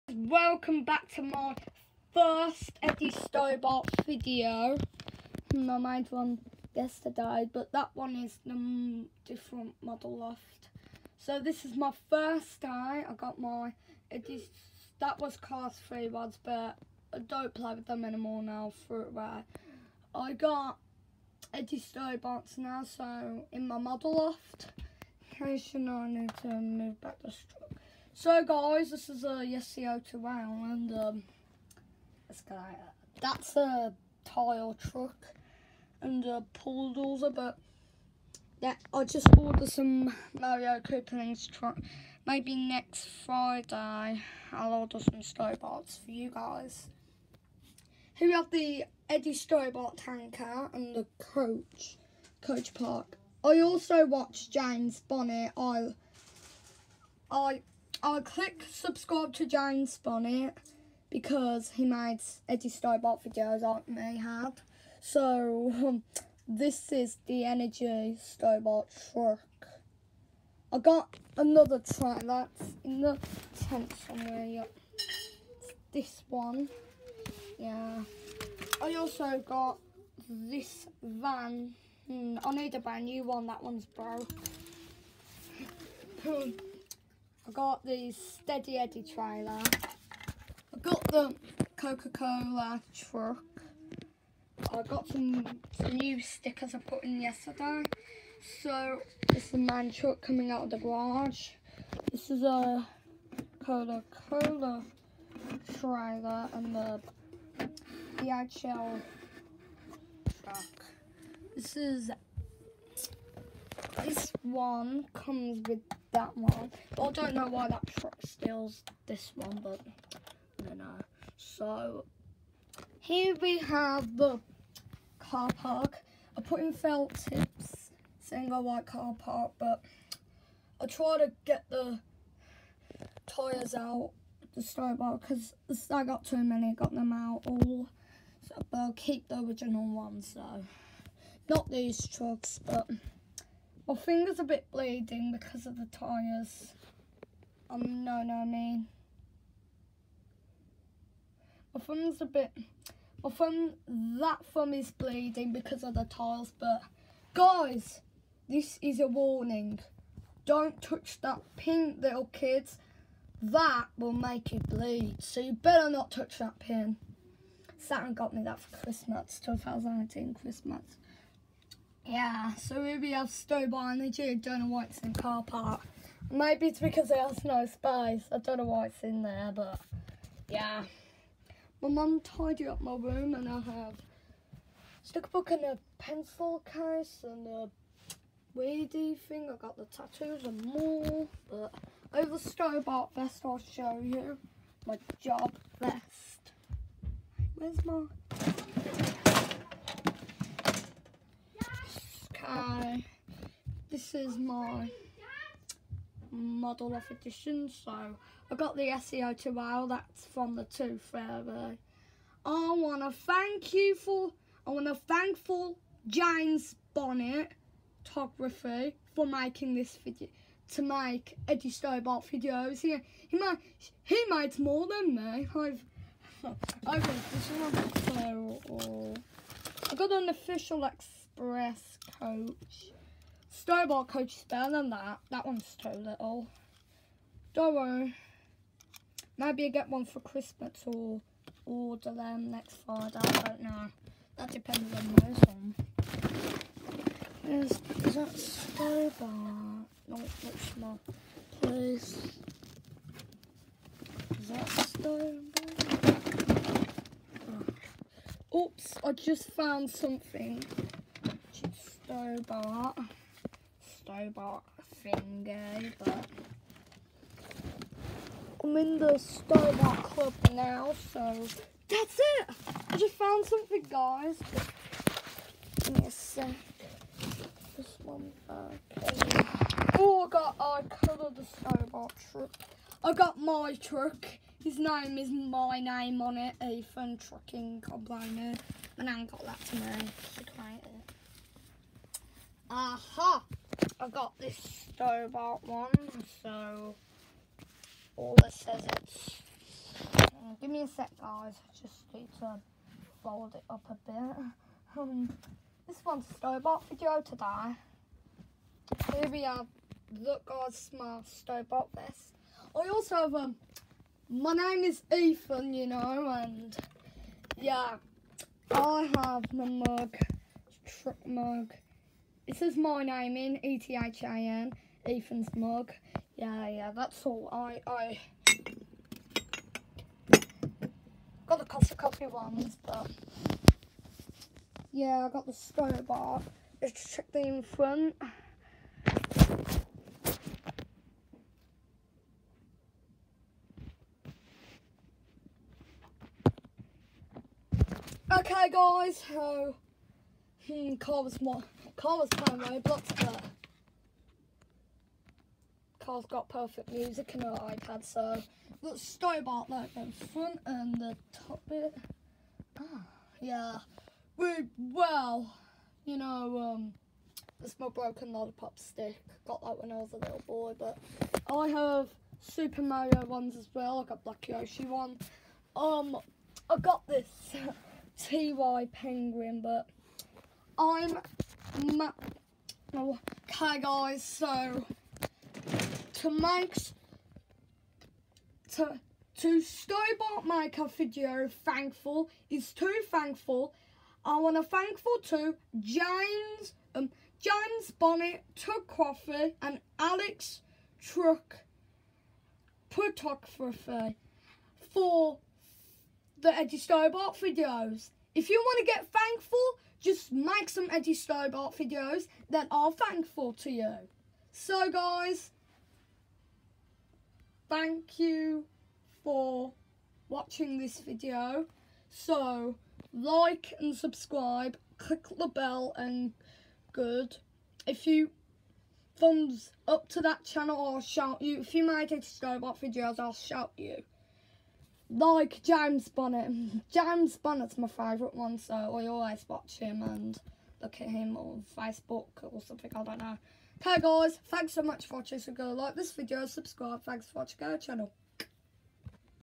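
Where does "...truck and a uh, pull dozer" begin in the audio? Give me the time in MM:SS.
00:34.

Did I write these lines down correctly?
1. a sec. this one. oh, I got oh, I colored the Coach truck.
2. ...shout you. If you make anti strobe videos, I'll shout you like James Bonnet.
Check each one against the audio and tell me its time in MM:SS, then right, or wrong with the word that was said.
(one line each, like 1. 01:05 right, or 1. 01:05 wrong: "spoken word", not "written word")
1. 04:36 wrong: "Starbucks", not "Coach"
2. 07:11 right.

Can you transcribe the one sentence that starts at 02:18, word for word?
So, but I'll keep the original ones though.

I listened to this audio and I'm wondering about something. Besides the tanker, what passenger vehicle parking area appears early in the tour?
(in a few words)
Coach Park.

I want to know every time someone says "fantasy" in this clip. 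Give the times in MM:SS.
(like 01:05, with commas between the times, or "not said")
not said.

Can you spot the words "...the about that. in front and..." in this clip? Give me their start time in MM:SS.
05:58.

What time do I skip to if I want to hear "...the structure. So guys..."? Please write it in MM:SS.
00:27.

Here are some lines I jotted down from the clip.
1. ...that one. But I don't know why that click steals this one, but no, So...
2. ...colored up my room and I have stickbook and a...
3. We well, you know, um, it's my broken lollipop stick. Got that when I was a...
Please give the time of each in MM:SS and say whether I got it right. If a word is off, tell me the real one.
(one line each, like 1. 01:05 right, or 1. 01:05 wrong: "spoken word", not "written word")
1. 01:56 wrong: "truck", not "click"
2. 03:02 wrong: "tidied", not "colored"
3. 06:04 right.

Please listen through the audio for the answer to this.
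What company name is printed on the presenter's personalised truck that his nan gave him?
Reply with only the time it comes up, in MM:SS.
04:46.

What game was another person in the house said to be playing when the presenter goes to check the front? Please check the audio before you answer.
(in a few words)
Roblox.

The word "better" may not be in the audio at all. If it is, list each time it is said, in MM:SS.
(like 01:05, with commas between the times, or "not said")
02:45, 03:54.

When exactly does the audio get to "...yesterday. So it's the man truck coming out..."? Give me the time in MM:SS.
01:37.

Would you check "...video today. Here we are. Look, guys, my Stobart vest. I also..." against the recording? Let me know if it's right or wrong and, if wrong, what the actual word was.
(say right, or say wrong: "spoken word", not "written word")
right.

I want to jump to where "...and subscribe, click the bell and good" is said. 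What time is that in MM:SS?
07:03.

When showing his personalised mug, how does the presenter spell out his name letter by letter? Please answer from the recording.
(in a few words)
E-T-H-I-N.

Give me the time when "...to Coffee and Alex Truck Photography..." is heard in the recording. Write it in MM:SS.
06:38.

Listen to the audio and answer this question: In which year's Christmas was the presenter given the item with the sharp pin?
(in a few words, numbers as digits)
2018.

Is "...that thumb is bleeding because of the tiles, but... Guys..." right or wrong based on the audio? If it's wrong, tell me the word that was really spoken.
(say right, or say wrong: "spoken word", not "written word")
right.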